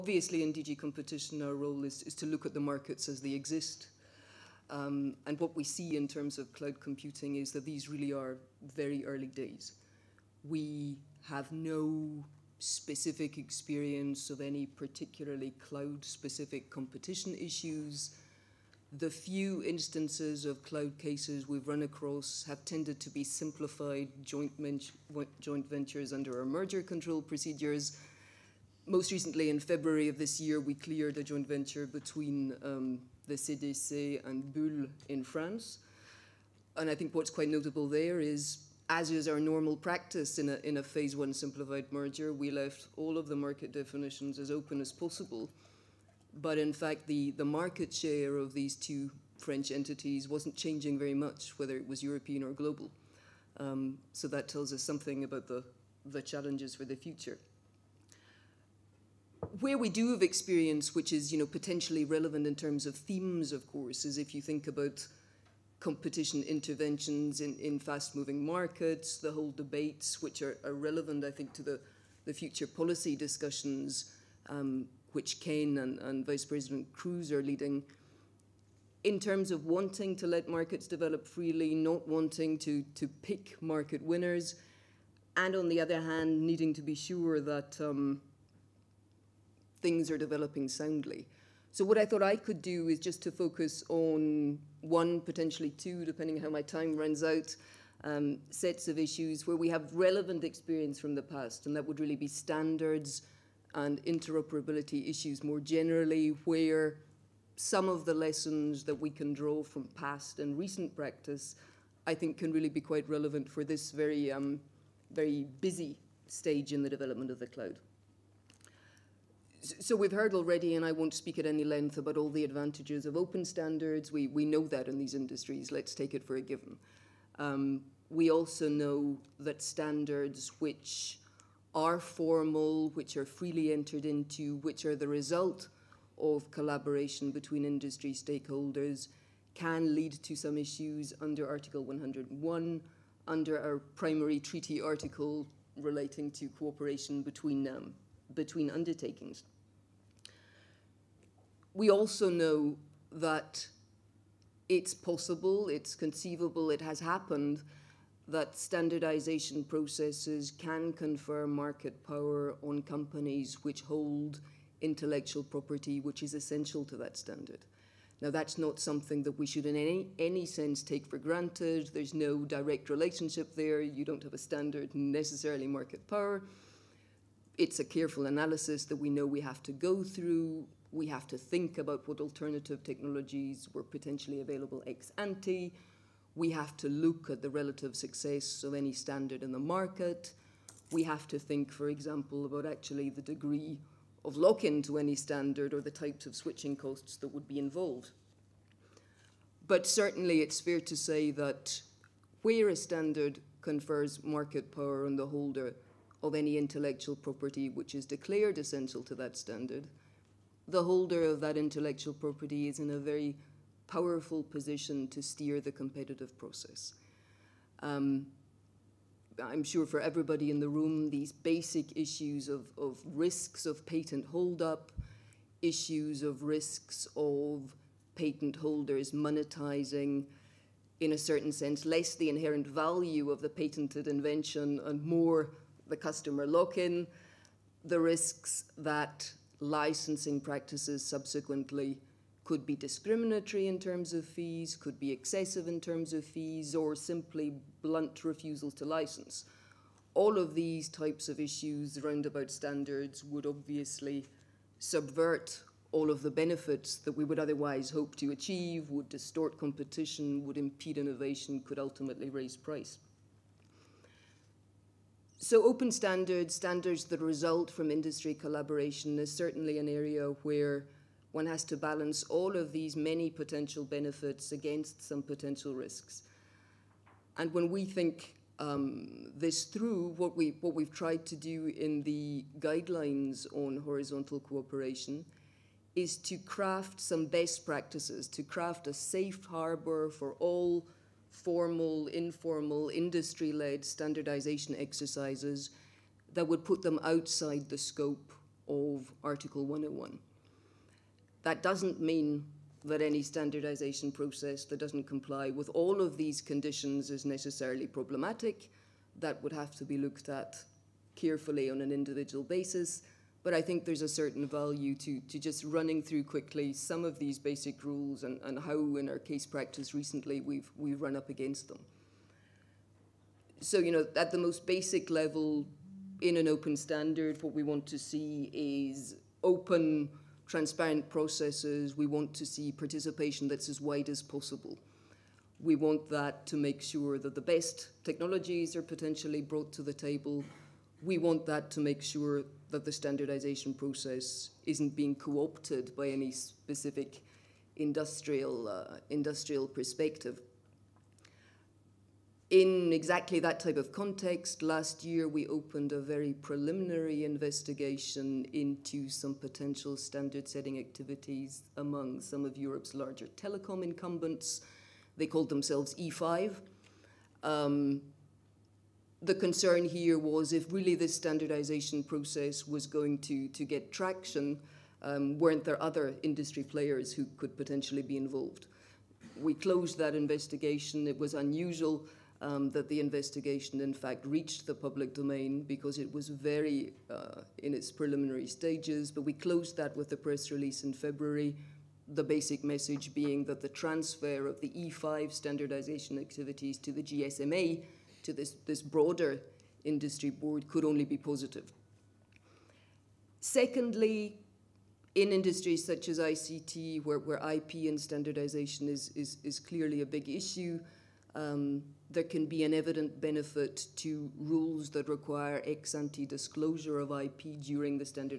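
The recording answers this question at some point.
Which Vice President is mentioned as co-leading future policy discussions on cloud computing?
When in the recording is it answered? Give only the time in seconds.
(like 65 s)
76 s.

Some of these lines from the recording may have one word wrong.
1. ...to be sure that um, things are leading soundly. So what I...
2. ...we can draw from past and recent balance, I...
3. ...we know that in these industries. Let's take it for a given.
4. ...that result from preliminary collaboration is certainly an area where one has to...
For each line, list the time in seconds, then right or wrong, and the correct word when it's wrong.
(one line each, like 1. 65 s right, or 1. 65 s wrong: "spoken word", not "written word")
1. 86 s wrong: "developing", not "leading"
2. 108 s wrong: "practice", not "balance"
3. 124 s right
4. 267 s wrong: "industry", not "preliminary".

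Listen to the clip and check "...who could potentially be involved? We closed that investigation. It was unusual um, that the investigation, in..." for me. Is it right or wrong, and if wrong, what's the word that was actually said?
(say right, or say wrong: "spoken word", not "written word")
right.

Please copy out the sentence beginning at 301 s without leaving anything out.
That doesn't mean that any standardization process that doesn't comply with all of these conditions is necessarily problematic.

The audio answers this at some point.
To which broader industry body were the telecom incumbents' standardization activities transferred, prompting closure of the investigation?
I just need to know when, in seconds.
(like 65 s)
397 s.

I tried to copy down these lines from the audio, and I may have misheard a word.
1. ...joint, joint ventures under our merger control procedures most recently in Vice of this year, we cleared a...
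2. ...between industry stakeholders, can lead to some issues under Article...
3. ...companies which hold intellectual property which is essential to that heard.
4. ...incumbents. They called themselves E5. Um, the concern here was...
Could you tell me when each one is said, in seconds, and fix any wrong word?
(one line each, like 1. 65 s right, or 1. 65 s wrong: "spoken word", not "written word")
1. 24 s wrong: "February", not "Vice"
2. 137 s right
3. 162 s wrong: "standard", not "heard"
4. 363 s right.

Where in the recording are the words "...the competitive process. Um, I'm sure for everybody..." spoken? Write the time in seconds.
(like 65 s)
215 s.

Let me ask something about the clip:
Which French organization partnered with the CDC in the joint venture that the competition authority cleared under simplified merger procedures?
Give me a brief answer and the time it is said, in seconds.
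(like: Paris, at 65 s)
Bull, at 34 s.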